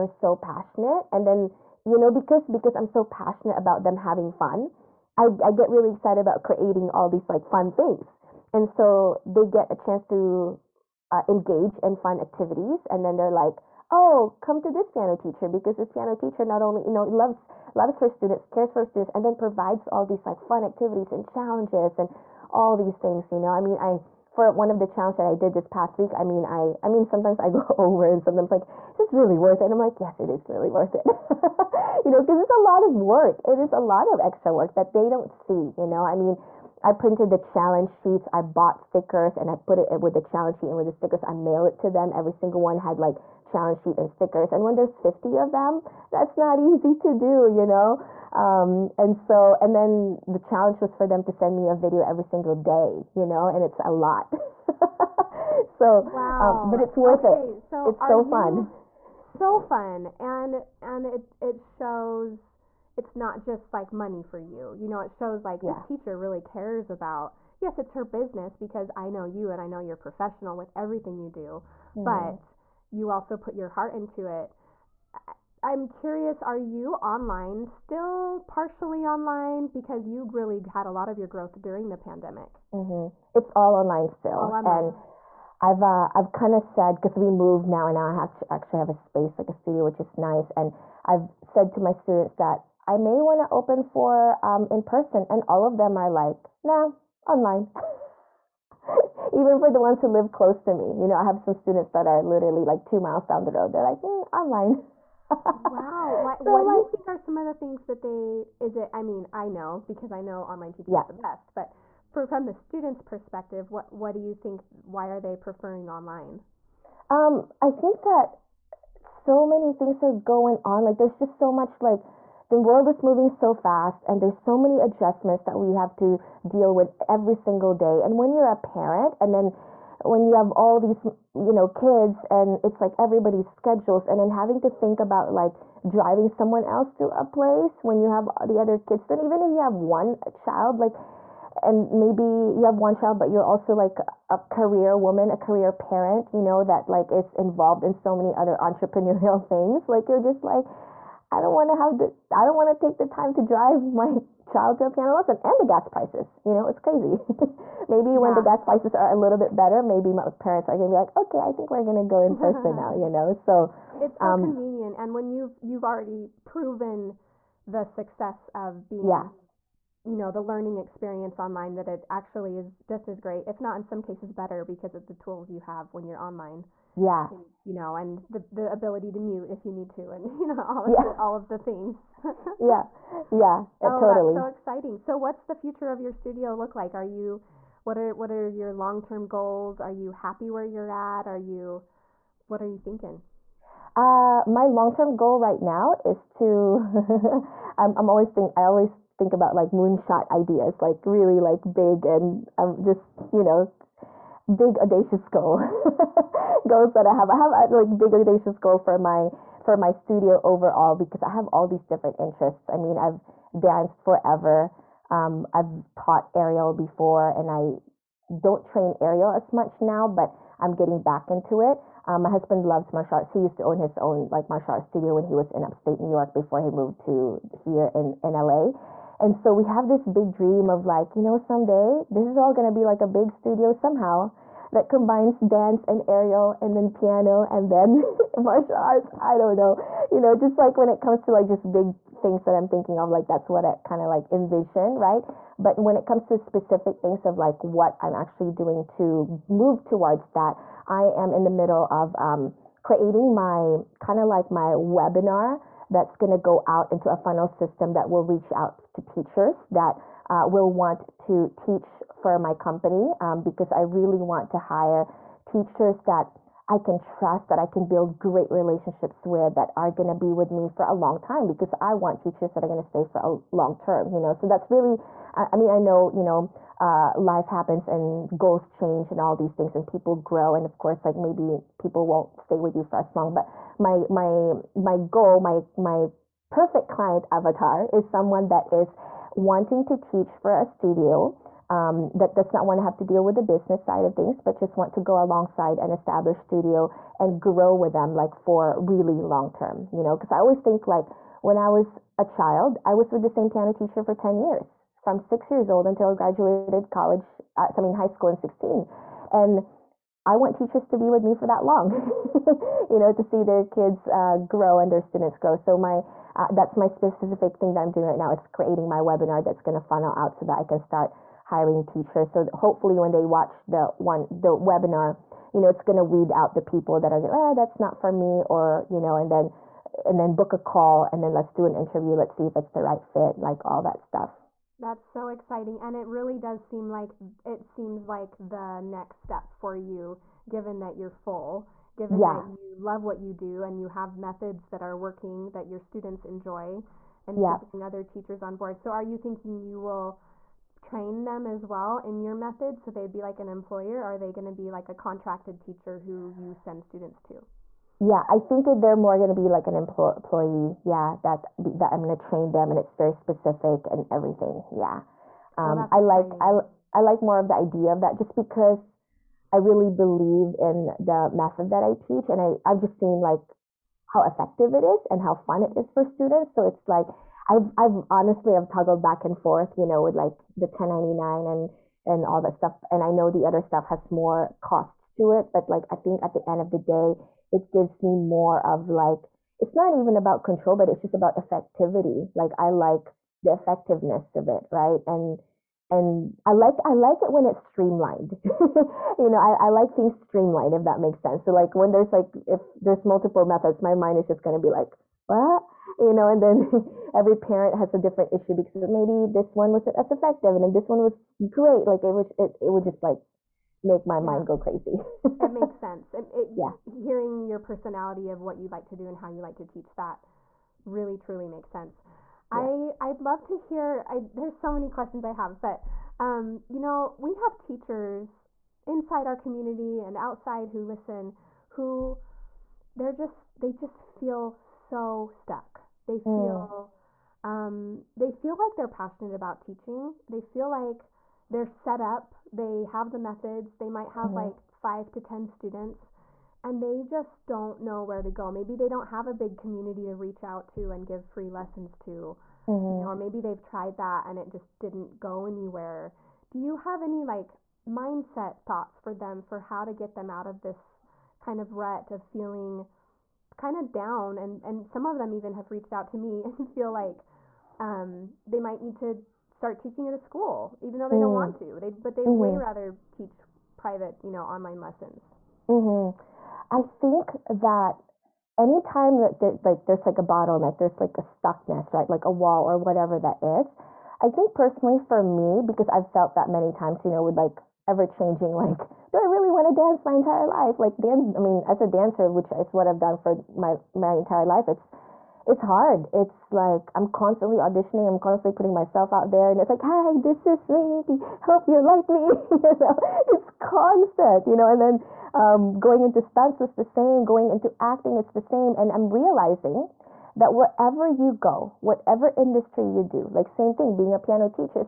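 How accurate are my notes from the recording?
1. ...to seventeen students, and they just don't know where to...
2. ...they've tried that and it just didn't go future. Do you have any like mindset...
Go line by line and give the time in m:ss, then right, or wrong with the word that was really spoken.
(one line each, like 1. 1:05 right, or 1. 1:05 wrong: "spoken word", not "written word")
1. 7:25 wrong: "ten", not "seventeen"
2. 7:33 wrong: "anywhere", not "future".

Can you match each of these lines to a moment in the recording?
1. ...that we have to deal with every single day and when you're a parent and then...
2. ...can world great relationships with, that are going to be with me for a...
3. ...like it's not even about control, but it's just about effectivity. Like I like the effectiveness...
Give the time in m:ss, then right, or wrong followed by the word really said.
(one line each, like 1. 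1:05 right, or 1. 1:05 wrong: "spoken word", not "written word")
1. 2:05 right
2. 4:27 wrong: "build", not "world"
3. 6:28 right.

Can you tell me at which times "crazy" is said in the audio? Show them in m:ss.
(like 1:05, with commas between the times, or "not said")
2:36, 6:54.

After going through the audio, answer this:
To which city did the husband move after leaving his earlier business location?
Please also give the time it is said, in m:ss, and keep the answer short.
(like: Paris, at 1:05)
LA, at 3:48.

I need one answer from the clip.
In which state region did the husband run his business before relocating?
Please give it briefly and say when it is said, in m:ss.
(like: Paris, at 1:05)
Upstate New York, at 3:45.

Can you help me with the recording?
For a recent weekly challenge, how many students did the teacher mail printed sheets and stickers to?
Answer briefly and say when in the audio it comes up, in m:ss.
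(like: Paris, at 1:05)
50, at 0:44.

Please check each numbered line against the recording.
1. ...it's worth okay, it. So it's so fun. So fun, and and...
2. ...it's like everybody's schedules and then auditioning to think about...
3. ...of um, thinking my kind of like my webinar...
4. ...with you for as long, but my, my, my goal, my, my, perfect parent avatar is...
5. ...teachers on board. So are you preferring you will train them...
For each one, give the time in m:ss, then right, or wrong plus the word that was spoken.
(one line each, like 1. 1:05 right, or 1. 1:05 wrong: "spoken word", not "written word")
1. 0:56 right
2. 2:12 wrong: "having", not "auditioning"
3. 4:11 wrong: "creating", not "thinking"
4. 4:42 wrong: "client", not "parent"
5. 5:48 wrong: "thinking", not "preferring".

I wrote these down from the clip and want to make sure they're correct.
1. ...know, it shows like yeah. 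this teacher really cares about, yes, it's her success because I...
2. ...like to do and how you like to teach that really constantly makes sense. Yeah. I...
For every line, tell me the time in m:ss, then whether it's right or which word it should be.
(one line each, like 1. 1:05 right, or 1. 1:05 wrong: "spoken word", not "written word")
1. 1:04 wrong: "business", not "success"
2. 6:58 wrong: "truly", not "constantly".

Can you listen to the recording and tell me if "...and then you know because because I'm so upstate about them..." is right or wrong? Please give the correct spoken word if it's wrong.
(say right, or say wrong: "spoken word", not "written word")
wrong: "passionate", not "upstate".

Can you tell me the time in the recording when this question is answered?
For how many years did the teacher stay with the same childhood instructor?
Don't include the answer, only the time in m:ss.
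5:04.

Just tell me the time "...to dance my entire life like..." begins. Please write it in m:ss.
8:09.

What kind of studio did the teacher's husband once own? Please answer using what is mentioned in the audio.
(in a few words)
Martial arts studio.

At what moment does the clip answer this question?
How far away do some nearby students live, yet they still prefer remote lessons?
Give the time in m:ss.
1:42.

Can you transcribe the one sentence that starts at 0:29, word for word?
And I'm like, yes, it is really worth it.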